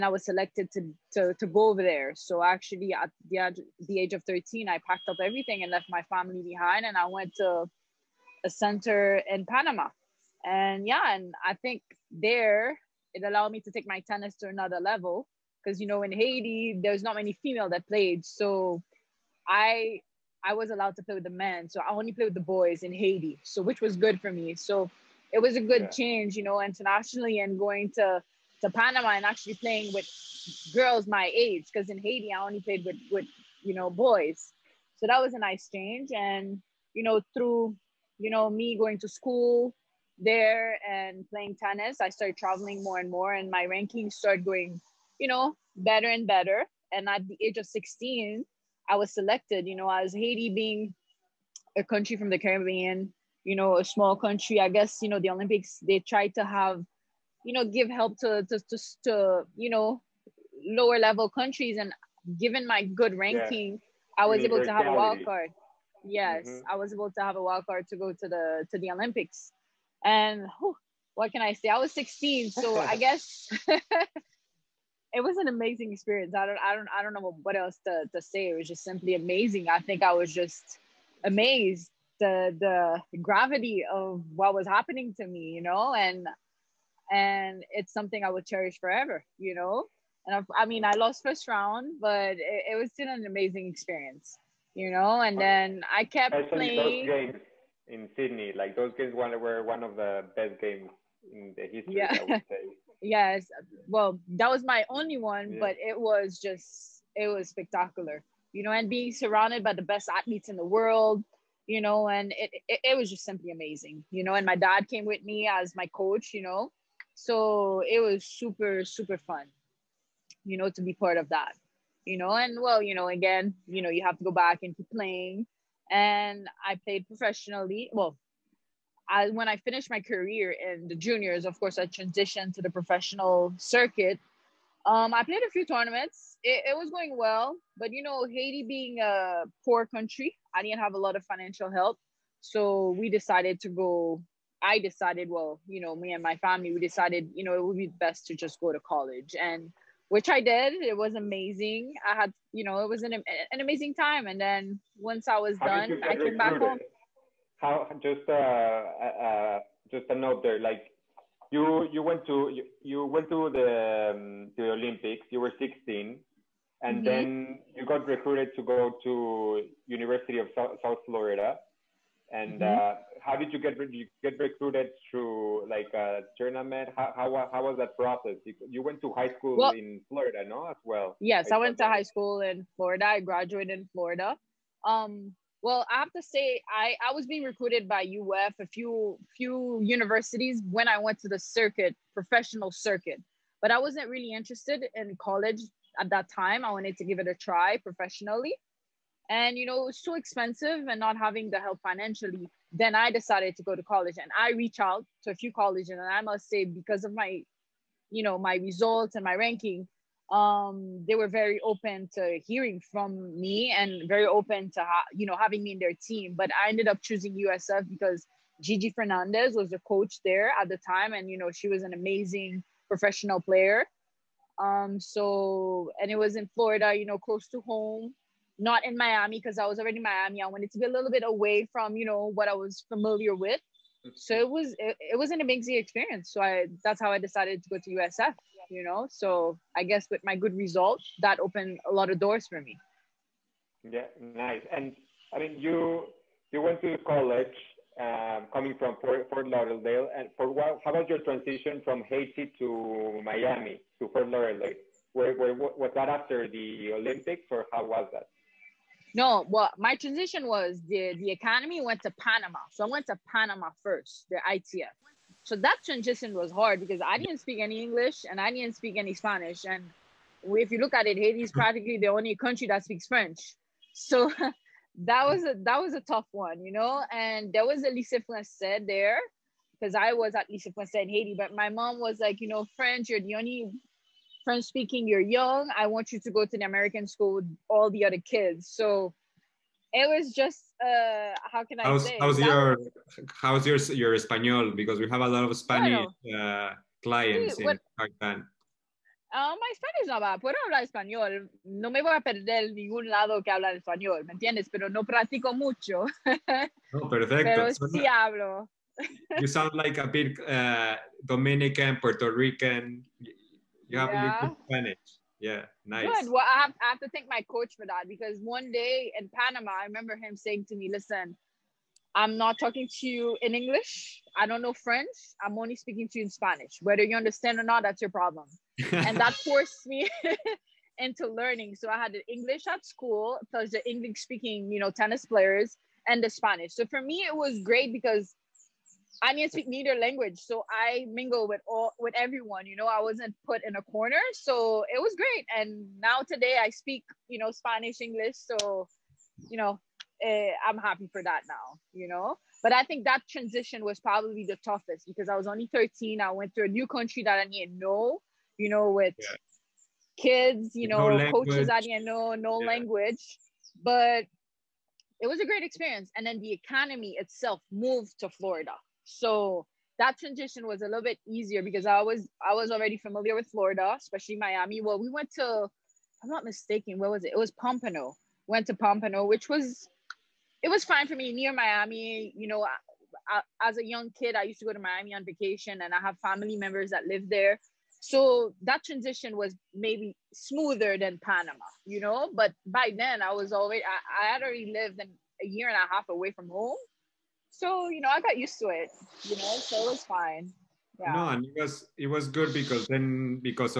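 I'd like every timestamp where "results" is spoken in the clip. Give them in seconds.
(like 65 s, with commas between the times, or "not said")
208 s, 240 s.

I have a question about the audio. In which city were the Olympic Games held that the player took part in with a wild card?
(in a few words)
Sydney.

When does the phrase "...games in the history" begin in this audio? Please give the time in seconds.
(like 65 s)
100 s.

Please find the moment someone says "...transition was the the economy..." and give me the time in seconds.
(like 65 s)
259 s.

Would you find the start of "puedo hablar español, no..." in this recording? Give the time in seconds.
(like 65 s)
300 s.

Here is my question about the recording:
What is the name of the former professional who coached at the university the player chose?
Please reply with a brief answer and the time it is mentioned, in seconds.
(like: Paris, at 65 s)
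Gigi Fernandez, at 218 s.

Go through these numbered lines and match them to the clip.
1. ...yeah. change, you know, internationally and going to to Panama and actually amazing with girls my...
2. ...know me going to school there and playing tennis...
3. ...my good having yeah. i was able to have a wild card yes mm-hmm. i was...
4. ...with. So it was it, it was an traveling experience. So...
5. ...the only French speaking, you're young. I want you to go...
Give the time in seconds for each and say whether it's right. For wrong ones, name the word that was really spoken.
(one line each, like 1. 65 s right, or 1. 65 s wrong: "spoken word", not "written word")
1. 25 s wrong: "playing", not "amazing"
2. 38 s right
3. 62 s wrong: "ranking", not "having"
4. 233 s wrong: "amazing", not "traveling"
5. 283 s right.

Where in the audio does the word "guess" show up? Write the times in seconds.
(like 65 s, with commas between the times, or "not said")
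54 s, 73 s, 239 s.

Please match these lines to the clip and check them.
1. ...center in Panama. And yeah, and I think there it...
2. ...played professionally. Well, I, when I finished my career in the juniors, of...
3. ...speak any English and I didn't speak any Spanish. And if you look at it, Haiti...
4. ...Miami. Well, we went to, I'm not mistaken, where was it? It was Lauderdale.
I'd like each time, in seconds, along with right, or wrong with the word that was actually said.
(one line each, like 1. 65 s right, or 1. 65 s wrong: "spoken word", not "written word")
1. 8 s right
2. 126 s right
3. 267 s right
4. 374 s wrong: "Pompano", not "Lauderdale".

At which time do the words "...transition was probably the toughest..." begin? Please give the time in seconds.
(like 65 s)
353 s.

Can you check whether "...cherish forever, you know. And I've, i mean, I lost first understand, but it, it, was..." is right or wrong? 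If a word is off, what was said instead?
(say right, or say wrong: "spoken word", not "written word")
wrong: "round", not "understand".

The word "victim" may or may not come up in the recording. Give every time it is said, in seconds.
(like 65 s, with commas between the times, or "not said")
not said.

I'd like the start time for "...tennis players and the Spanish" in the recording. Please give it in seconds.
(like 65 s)
334 s.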